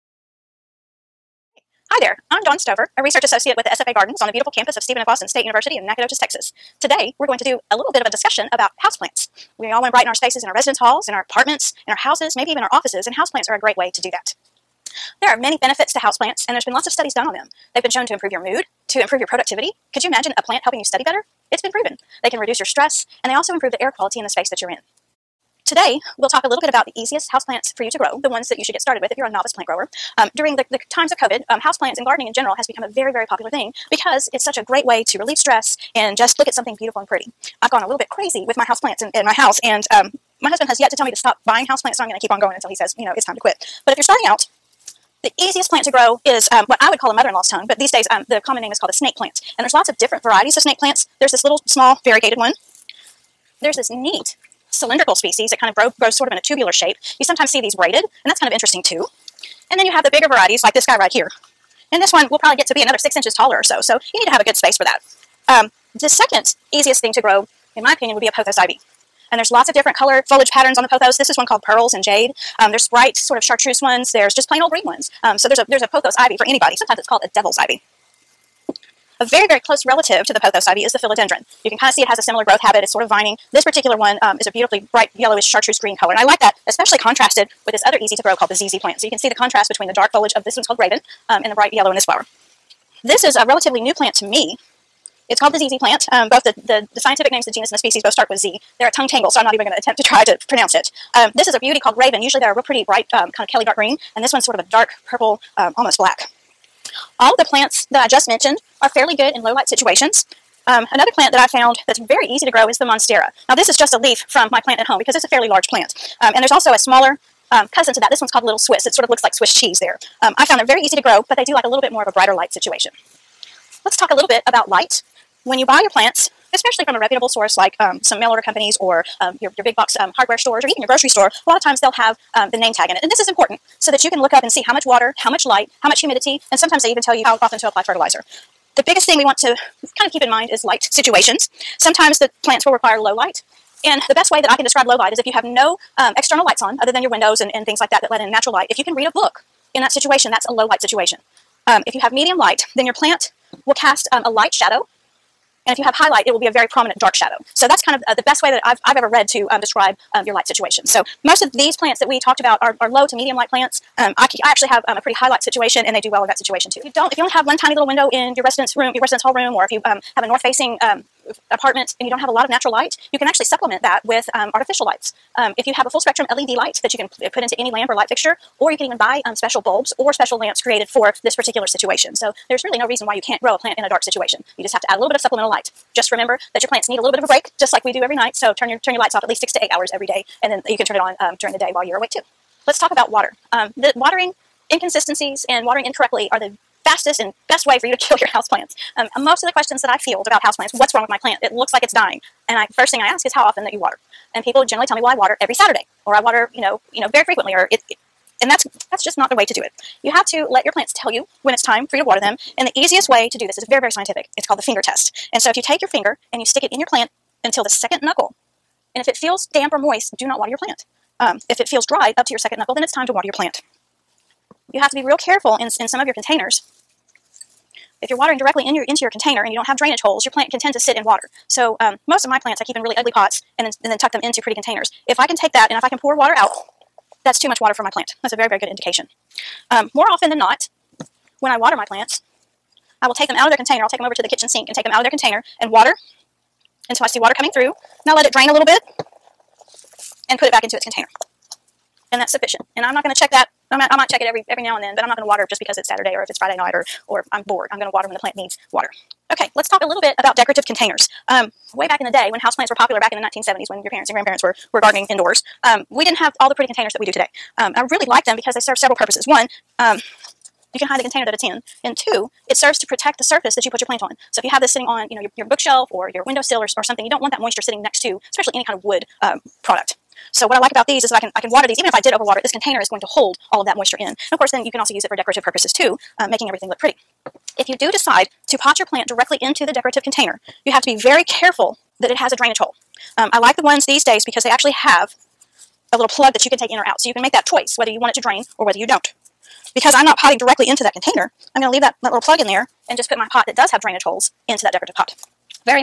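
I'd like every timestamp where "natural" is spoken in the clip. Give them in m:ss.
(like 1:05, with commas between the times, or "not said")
2:28, 2:52.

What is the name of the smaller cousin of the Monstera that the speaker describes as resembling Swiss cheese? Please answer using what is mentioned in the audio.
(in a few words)
Little Swiss.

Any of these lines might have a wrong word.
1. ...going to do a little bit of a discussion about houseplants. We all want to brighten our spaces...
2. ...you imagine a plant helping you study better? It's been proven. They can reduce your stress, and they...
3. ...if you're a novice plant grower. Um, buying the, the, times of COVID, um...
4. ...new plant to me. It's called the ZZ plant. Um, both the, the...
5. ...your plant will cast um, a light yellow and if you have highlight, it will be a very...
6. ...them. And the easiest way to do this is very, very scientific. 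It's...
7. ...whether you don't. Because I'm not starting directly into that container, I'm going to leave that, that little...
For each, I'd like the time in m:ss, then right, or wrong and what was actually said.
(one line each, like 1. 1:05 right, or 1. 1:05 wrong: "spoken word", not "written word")
1. 0:07 right
2. 0:20 right
3. 0:29 wrong: "during", not "buying"
4. 1:33 right
5. 2:32 wrong: "shadow", not "yellow"
6. 3:32 right
7. 4:58 wrong: "potting", not "starting".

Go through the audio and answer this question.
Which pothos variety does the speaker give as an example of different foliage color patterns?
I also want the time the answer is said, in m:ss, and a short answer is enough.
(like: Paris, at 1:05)
Pearls and Jade, at 1:11.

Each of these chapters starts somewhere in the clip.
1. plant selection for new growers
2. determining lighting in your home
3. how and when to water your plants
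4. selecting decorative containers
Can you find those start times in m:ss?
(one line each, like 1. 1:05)
1. 0:43
2. 2:03
3. 3:12
4. 4:19.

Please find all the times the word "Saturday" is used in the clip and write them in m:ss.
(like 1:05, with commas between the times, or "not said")
3:25, 4:15.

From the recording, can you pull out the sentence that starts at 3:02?
So there's really no reason why you can't grow a plant in a dark situation.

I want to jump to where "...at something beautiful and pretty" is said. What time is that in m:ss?
0:36.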